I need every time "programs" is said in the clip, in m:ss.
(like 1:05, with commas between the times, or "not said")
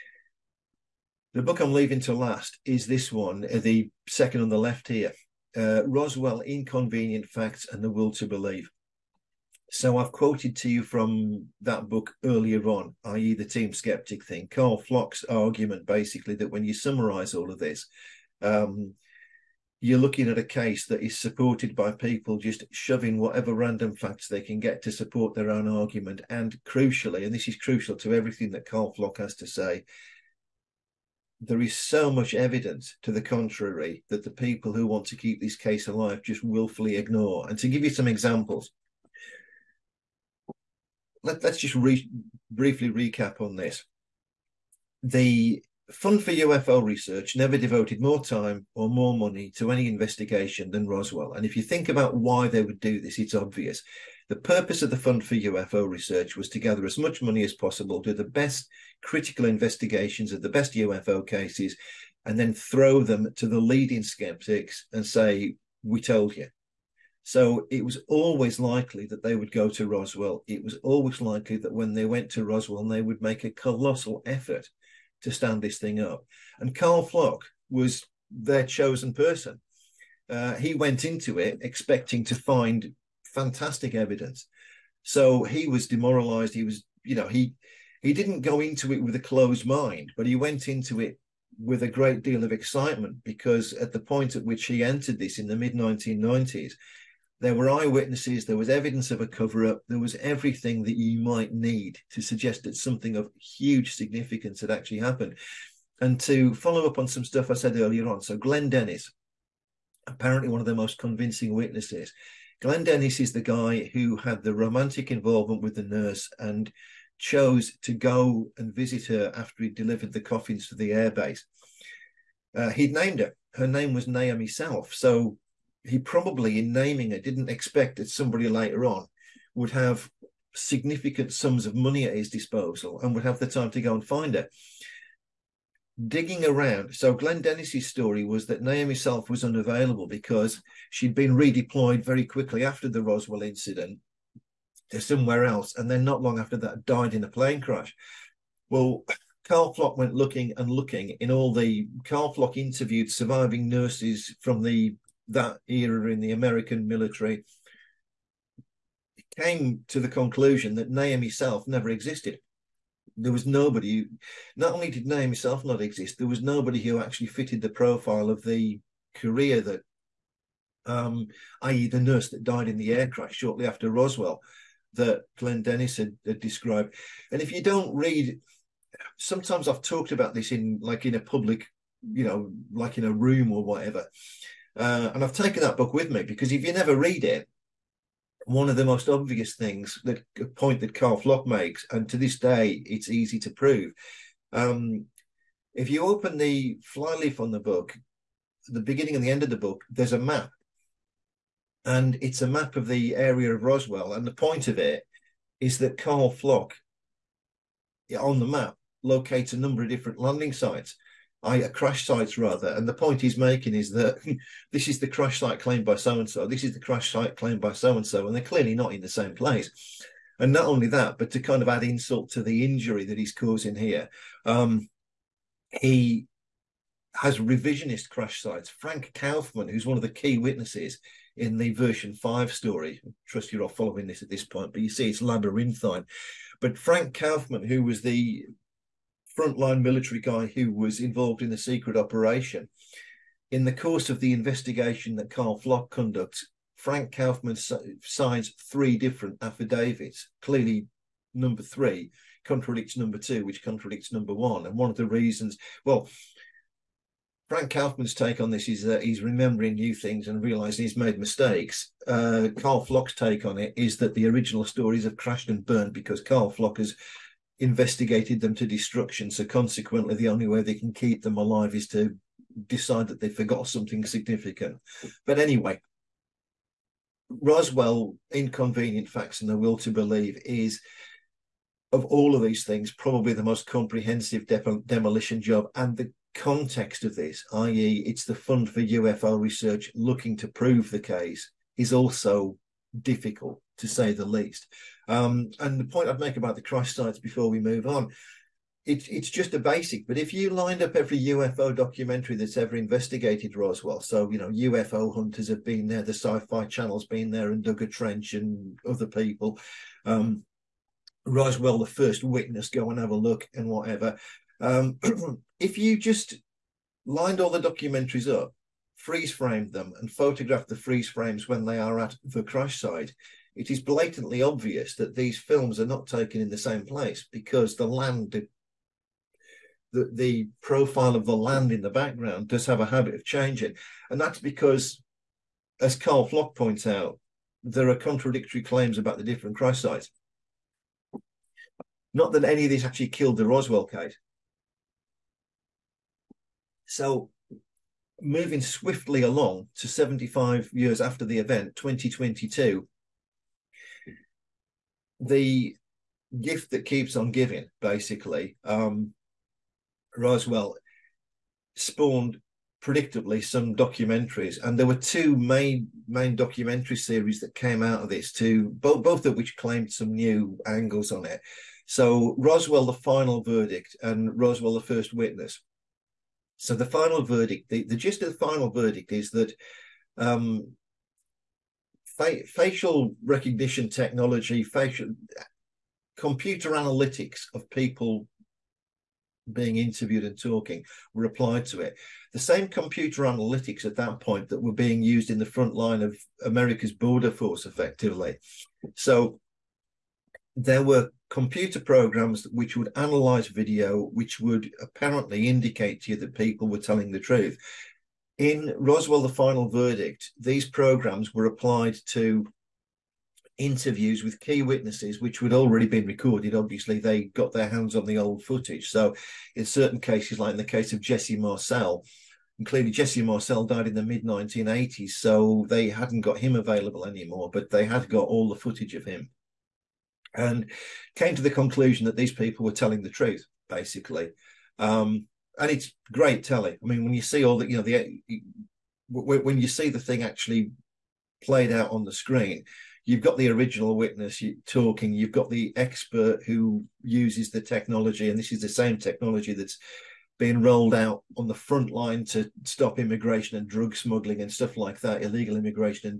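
6:41, 6:50.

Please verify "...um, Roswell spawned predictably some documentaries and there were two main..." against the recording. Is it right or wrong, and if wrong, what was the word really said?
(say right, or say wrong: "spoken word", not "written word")
right.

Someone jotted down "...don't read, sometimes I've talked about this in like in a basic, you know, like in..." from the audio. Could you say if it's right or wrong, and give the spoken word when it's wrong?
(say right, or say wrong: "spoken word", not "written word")
wrong: "public", not "basic".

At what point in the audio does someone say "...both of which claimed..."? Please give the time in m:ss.
6:09.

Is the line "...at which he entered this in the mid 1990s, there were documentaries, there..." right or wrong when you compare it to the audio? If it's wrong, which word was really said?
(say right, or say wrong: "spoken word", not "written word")
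wrong: "eyewitnesses", not "documentaries".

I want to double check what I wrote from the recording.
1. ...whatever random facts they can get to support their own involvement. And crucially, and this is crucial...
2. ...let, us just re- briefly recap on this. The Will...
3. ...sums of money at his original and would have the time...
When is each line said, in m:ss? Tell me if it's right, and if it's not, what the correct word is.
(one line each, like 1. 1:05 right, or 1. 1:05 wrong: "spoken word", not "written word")
1. 0:23 wrong: "argument", not "involvement"
2. 0:41 wrong: "Fund", not "Will"
3. 2:11 wrong: "disposal", not "original".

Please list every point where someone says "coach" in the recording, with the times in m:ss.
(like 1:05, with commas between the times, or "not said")
not said.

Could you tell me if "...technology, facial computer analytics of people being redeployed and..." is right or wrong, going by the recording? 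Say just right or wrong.
wrong.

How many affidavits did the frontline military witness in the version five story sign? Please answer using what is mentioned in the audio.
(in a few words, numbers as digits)
3.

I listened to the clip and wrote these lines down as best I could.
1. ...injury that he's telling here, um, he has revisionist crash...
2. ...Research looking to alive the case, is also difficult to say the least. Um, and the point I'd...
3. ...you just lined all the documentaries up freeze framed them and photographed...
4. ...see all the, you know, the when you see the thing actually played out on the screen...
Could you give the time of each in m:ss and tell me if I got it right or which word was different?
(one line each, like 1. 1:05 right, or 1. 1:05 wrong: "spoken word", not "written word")
1. 3:42 wrong: "causing", not "telling"
2. 4:49 wrong: "prove", not "alive"
3. 5:15 right
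4. 7:17 right.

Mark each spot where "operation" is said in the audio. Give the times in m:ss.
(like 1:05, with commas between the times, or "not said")
4:01.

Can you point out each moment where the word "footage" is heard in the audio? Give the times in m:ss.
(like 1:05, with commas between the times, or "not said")
6:58, 7:08.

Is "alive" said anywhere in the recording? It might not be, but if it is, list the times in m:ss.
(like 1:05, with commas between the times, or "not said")
0:35, 4:31.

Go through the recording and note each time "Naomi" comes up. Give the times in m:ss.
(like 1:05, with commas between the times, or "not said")
2:04, 2:18, 2:40, 2:45.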